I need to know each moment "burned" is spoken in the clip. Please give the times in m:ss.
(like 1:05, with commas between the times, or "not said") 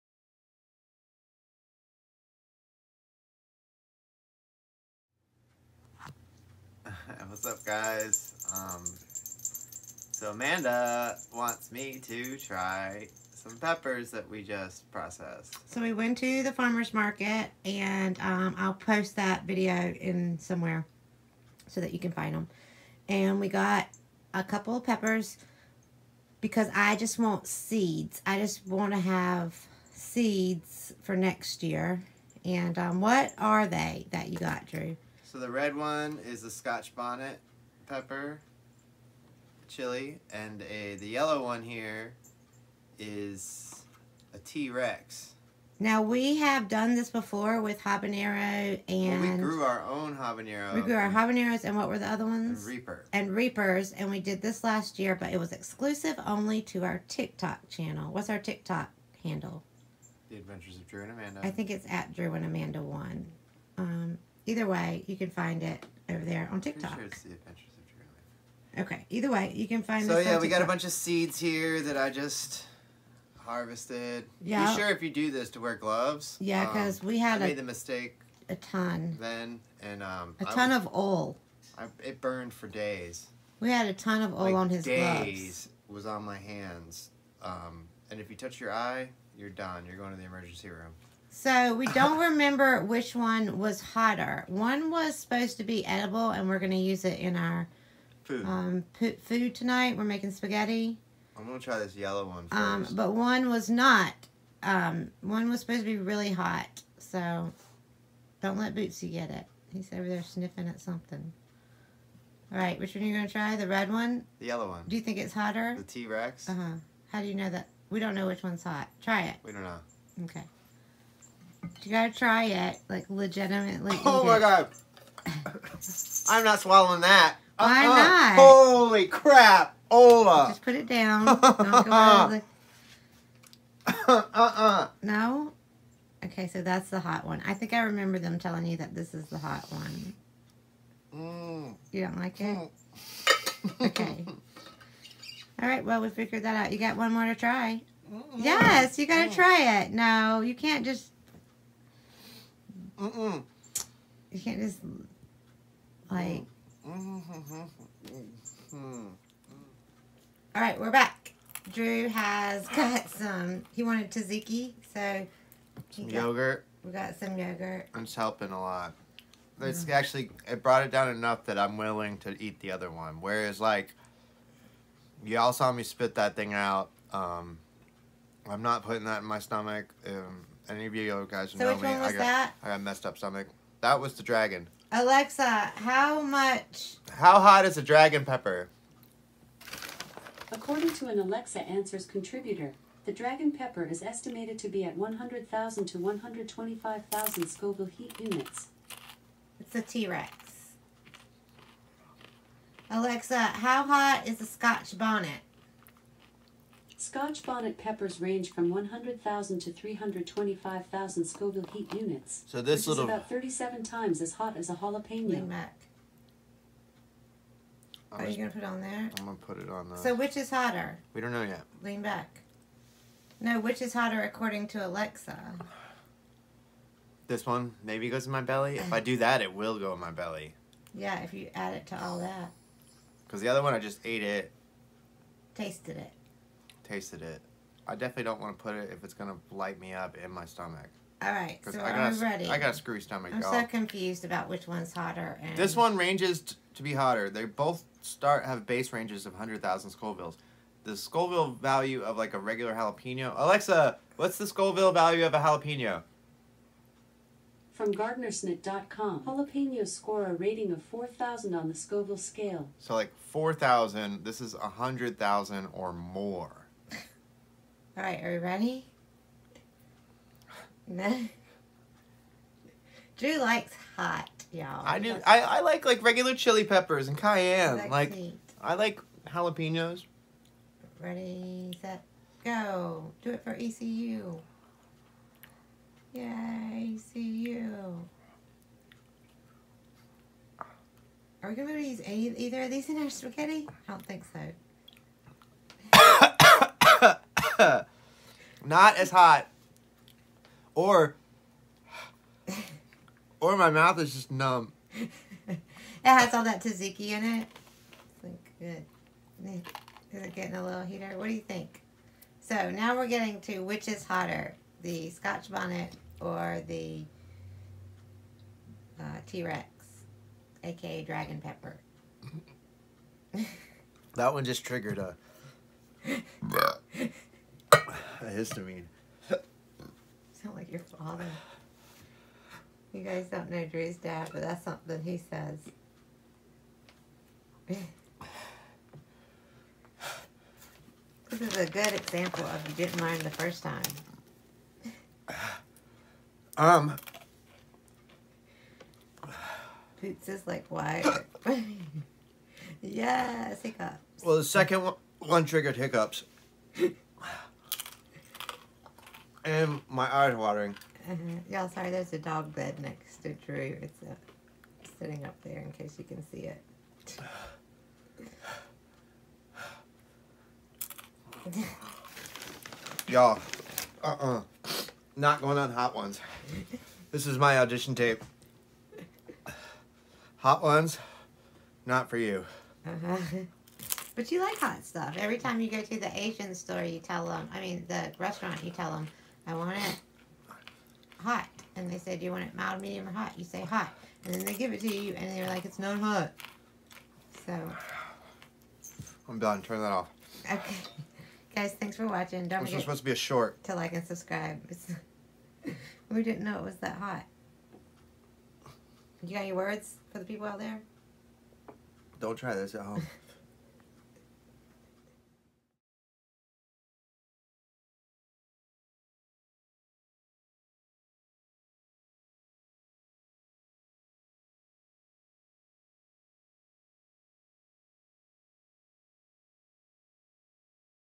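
1:22.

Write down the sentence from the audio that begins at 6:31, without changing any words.
And they said, you want it mild, medium, or hot?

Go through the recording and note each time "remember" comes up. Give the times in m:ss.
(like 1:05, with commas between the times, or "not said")
1:32, 2:17.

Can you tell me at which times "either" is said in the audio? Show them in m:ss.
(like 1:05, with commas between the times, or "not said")
1:04, 1:09, 4:52.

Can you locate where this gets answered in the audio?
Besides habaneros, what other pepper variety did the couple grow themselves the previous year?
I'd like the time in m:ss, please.
0:52.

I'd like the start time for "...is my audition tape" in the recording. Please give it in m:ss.
6:17.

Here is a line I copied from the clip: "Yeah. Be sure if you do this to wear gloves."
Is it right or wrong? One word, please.
right.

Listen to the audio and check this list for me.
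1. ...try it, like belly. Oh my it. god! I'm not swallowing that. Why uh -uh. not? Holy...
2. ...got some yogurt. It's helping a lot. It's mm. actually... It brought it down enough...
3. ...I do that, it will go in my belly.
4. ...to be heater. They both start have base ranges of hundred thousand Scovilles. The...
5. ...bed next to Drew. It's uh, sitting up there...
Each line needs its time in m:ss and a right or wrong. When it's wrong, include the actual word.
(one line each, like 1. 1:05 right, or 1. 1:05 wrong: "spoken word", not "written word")
1. 2:02 wrong: "legitimately", not "belly"
2. 2:46 right
3. 3:48 right
4. 4:06 wrong: "hotter", not "heater"
5. 6:02 right.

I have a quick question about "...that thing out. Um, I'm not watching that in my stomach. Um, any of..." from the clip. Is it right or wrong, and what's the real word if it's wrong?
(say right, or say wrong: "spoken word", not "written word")
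wrong: "putting", not "watching".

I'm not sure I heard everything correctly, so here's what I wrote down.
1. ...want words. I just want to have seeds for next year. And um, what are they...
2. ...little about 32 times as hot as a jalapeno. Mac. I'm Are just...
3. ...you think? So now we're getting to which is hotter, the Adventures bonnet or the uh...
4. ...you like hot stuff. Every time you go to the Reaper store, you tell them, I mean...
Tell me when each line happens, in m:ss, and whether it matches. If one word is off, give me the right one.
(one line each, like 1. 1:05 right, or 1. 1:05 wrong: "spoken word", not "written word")
1. 0:27 wrong: "seeds", not "words"
2. 3:32 wrong: "37", not "32"
3. 5:11 wrong: "Scotch", not "Adventures"
4. 6:24 wrong: "Asian", not "Reaper".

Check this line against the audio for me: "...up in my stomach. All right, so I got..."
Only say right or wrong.
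right.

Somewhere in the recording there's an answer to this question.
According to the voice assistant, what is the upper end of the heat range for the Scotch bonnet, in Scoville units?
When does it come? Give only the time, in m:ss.
3:29.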